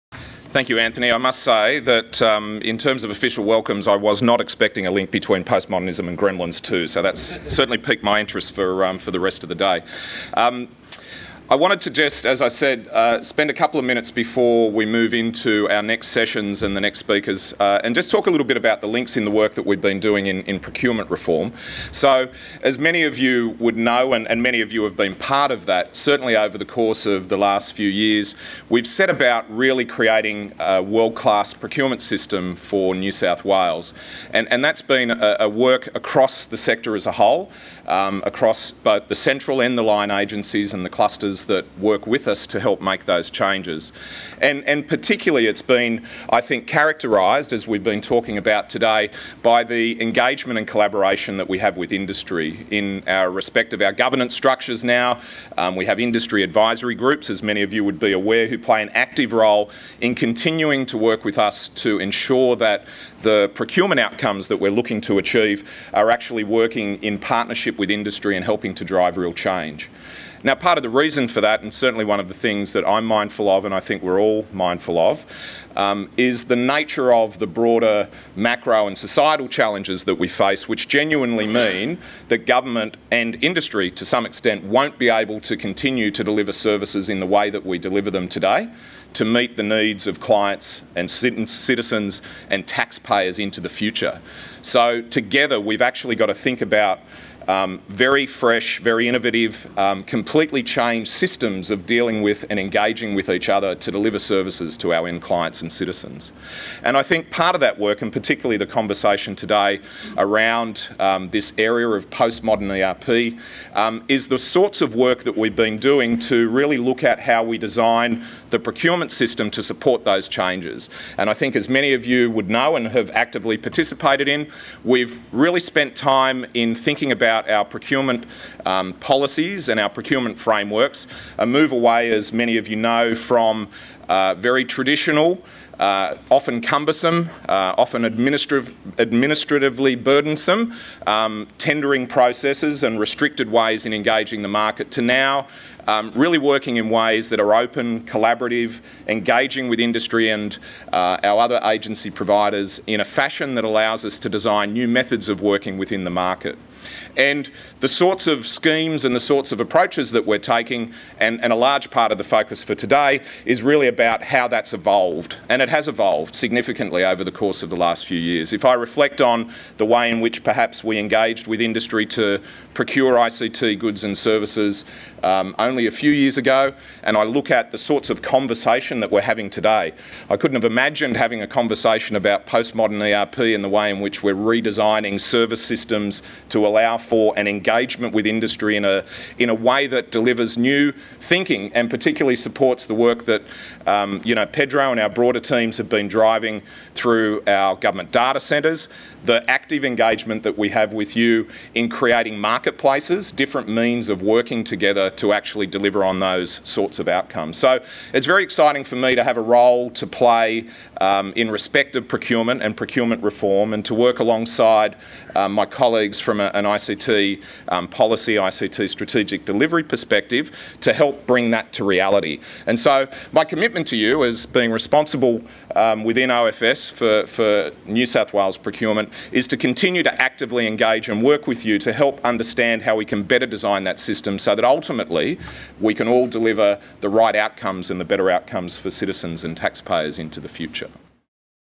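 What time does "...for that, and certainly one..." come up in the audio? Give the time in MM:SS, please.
01:11.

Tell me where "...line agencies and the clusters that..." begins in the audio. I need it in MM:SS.
00:39.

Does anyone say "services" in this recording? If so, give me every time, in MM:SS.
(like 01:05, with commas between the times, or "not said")
01:26, 01:44, 02:54, 03:05.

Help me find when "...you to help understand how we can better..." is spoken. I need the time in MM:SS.
03:51.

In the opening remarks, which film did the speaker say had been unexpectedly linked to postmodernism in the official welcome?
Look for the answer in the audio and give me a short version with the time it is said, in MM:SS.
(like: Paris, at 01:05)
Gremlins 2, at 00:06.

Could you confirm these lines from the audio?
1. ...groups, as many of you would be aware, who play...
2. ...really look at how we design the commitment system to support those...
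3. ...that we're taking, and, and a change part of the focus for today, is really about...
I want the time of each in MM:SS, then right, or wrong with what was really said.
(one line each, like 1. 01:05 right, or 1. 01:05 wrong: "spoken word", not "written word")
1. 00:56 right
2. 01:56 wrong: "procurement", not "commitment"
3. 02:40 wrong: "large", not "change".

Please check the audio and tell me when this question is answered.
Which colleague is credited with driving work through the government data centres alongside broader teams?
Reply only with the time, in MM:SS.
03:14.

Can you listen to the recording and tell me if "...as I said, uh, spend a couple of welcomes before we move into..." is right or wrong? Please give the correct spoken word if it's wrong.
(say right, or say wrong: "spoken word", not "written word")
wrong: "minutes", not "welcomes".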